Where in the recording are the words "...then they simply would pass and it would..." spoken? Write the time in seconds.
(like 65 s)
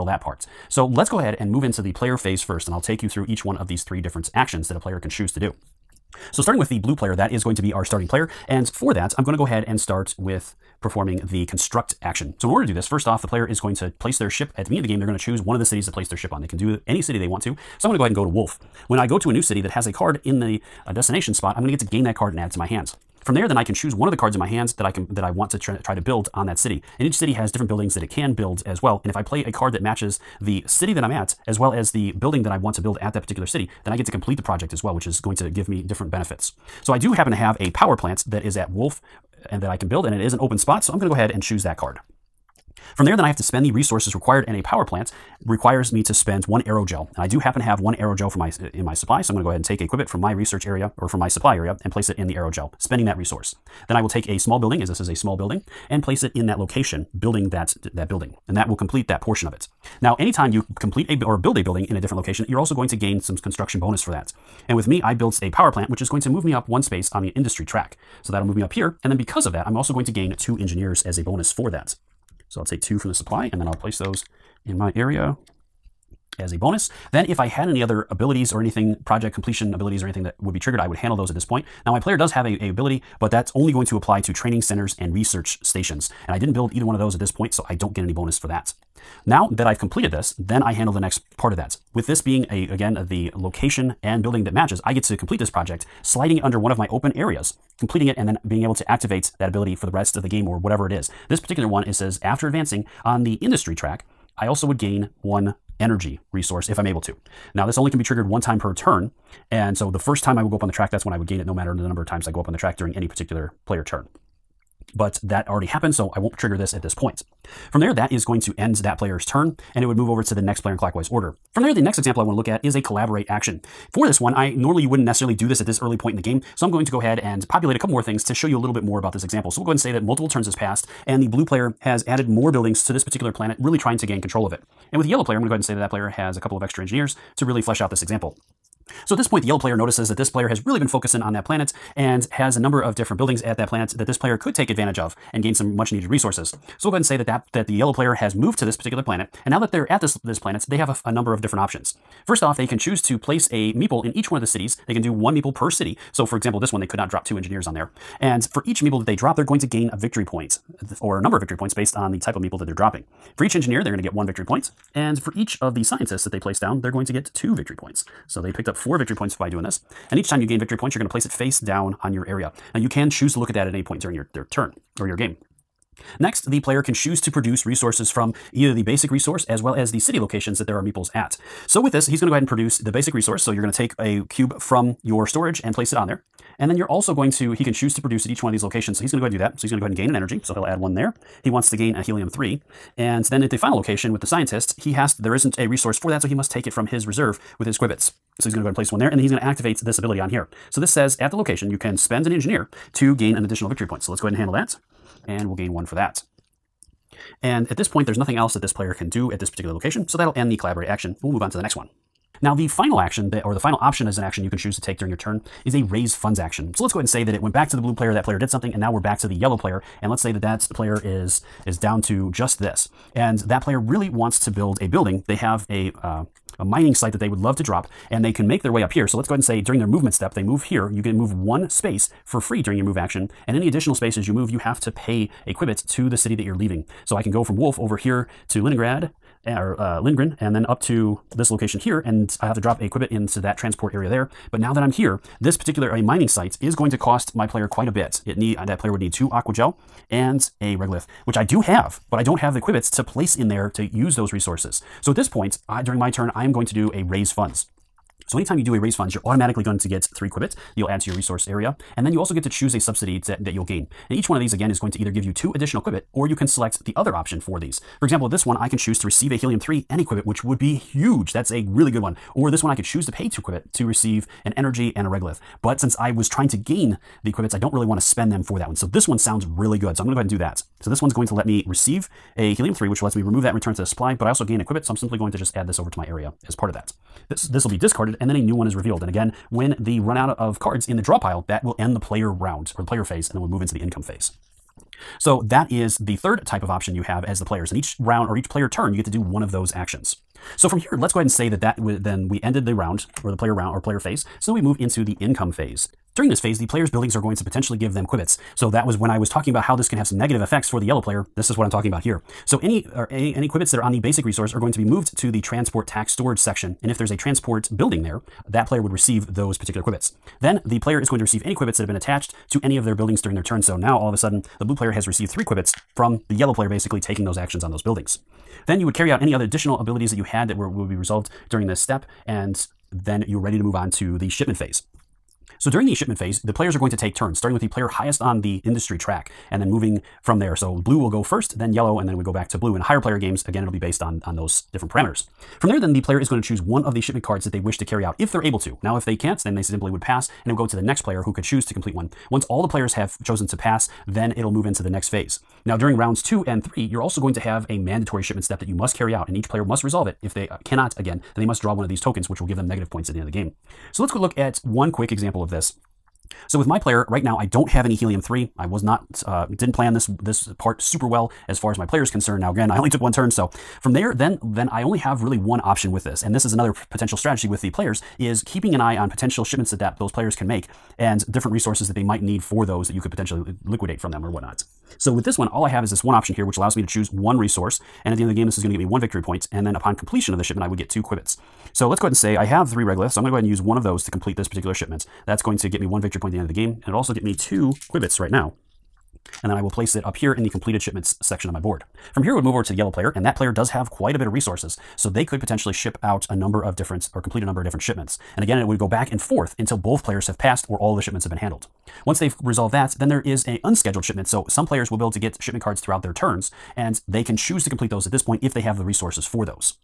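349 s.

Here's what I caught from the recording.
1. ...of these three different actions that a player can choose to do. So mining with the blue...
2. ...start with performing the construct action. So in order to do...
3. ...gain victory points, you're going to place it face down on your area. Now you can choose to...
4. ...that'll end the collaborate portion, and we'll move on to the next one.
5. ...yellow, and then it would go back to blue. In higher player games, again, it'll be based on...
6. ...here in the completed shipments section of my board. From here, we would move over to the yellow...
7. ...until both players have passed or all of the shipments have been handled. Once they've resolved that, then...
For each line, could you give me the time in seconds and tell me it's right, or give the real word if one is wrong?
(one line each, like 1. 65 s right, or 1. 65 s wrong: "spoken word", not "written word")
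1. 3 s wrong: "starting", not "mining"
2. 9 s right
3. 170 s right
4. 210 s wrong: "action", not "portion"
5. 341 s right
6. 400 s right
7. 409 s right.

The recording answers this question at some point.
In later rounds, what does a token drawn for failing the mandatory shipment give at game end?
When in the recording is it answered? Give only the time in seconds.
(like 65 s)
362 s.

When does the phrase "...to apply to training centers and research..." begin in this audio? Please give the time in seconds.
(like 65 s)
83 s.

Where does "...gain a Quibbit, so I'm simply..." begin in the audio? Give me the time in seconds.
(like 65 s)
284 s.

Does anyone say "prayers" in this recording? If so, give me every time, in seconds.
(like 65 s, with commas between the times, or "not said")
not said.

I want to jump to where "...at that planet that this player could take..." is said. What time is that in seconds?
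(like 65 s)
143 s.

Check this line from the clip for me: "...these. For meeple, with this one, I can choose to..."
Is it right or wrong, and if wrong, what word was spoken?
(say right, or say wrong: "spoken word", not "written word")
wrong: "example", not "meeple".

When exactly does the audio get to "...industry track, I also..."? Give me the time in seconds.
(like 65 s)
103 s.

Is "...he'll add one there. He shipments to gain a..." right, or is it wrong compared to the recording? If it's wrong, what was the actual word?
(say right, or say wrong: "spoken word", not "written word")
wrong: "wants", not "shipments".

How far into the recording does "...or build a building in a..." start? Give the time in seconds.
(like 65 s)
61 s.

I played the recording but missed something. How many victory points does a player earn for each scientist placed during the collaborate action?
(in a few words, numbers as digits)
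2.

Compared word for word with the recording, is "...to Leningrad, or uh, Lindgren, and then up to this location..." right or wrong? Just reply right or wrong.
right.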